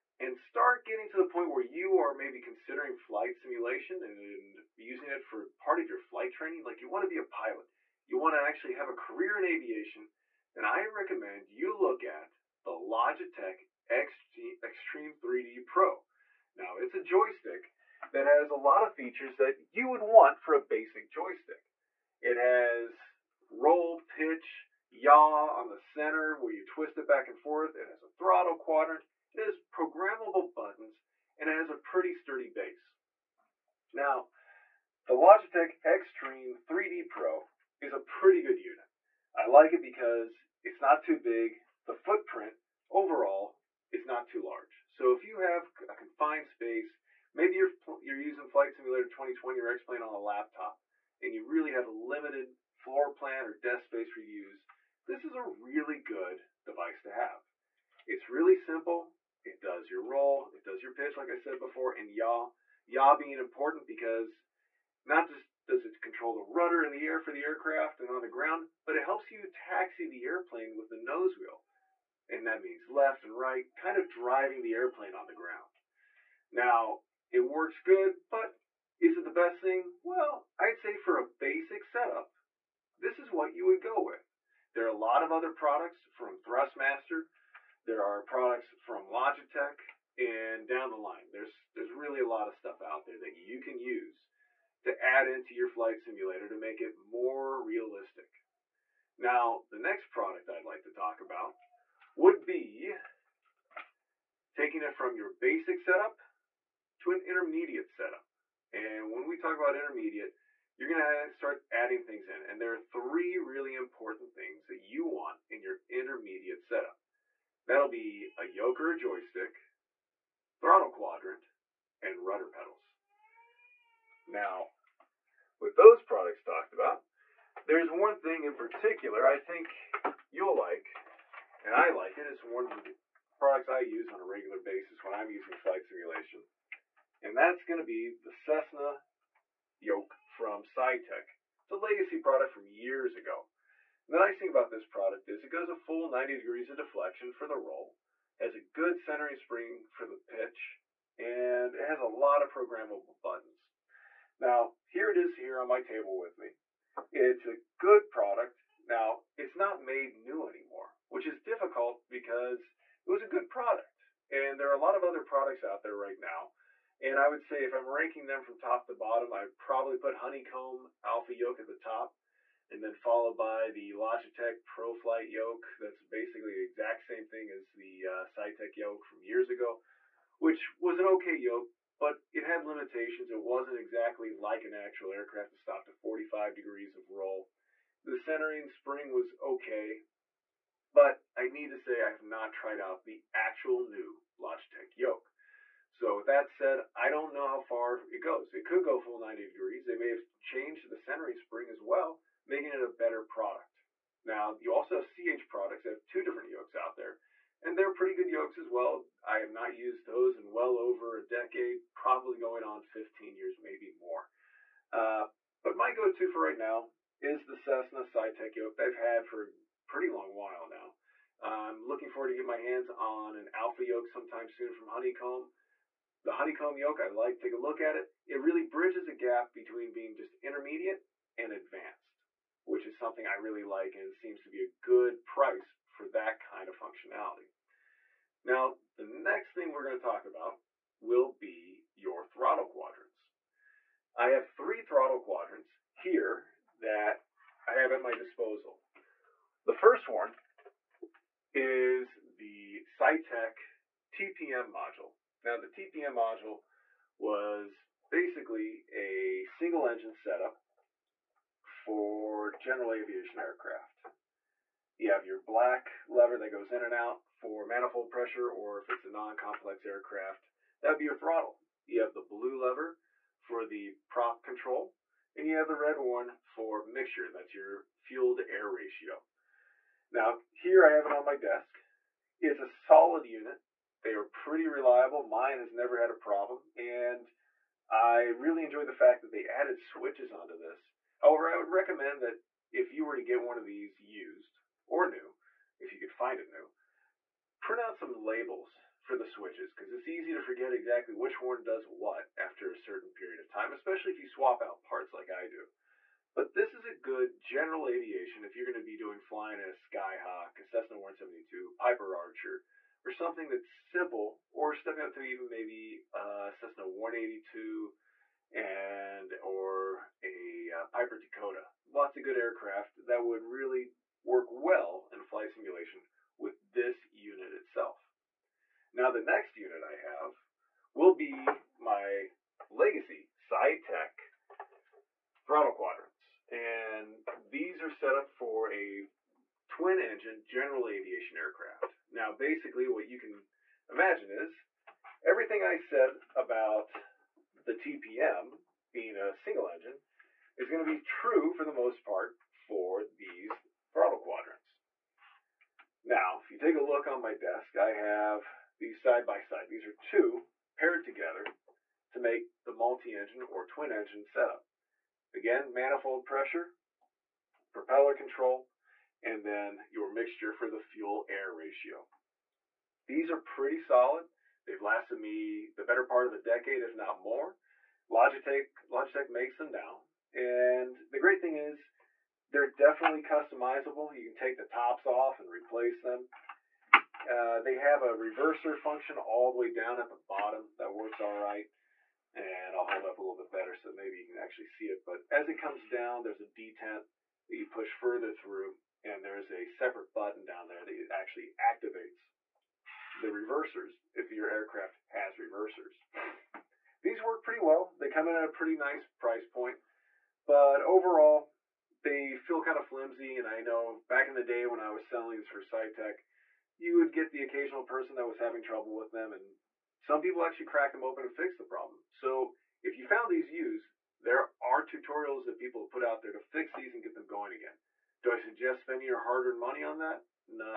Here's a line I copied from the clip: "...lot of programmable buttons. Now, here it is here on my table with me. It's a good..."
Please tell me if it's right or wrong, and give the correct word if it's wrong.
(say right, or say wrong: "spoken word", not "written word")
right.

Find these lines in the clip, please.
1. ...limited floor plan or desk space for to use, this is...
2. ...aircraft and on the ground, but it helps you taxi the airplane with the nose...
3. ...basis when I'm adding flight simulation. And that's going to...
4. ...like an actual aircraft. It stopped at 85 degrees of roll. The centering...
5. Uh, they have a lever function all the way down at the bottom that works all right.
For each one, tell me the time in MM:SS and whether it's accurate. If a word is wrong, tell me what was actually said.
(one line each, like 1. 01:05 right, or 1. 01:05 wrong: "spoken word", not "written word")
1. 00:51 right
2. 01:07 right
3. 02:14 wrong: "using", not "adding"
4. 03:04 wrong: "45", not "85"
5. 06:27 wrong: "reverser", not "lever".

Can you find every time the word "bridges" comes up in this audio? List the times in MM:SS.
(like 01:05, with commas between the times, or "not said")
03:48.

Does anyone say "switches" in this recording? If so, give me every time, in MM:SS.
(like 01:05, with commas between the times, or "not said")
04:49, 04:59.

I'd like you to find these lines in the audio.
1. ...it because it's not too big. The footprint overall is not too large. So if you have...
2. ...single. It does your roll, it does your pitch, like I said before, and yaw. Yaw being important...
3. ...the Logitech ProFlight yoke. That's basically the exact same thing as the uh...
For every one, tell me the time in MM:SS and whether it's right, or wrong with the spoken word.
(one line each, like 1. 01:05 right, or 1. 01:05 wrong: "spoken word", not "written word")
1. 00:39 right
2. 00:58 wrong: "simple", not "single"
3. 02:53 right.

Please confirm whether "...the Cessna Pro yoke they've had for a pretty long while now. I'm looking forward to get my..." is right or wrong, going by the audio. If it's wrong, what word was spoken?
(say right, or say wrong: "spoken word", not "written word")
wrong: "Saitek", not "Pro".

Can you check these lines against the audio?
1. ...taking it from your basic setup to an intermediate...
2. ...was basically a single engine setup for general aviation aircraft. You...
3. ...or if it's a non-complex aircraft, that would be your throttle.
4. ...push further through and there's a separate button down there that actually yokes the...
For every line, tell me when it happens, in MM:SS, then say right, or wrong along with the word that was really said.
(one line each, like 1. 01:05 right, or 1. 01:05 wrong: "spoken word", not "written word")
1. 01:44 right
2. 04:17 right
3. 04:28 right
4. 06:37 wrong: "activates", not "yokes".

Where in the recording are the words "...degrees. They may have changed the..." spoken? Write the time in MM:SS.
03:19.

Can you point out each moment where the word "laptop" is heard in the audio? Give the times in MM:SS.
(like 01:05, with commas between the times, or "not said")
00:50.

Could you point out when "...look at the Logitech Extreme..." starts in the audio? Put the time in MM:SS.
00:11.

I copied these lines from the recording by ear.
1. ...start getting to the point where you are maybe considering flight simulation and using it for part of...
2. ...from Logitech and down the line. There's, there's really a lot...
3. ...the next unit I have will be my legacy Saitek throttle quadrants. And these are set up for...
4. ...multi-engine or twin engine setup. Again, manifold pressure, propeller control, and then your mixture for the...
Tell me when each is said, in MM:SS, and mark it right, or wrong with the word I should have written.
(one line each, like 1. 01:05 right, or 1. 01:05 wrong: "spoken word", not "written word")
1. 00:00 right
2. 01:28 right
3. 05:29 right
4. 06:02 right.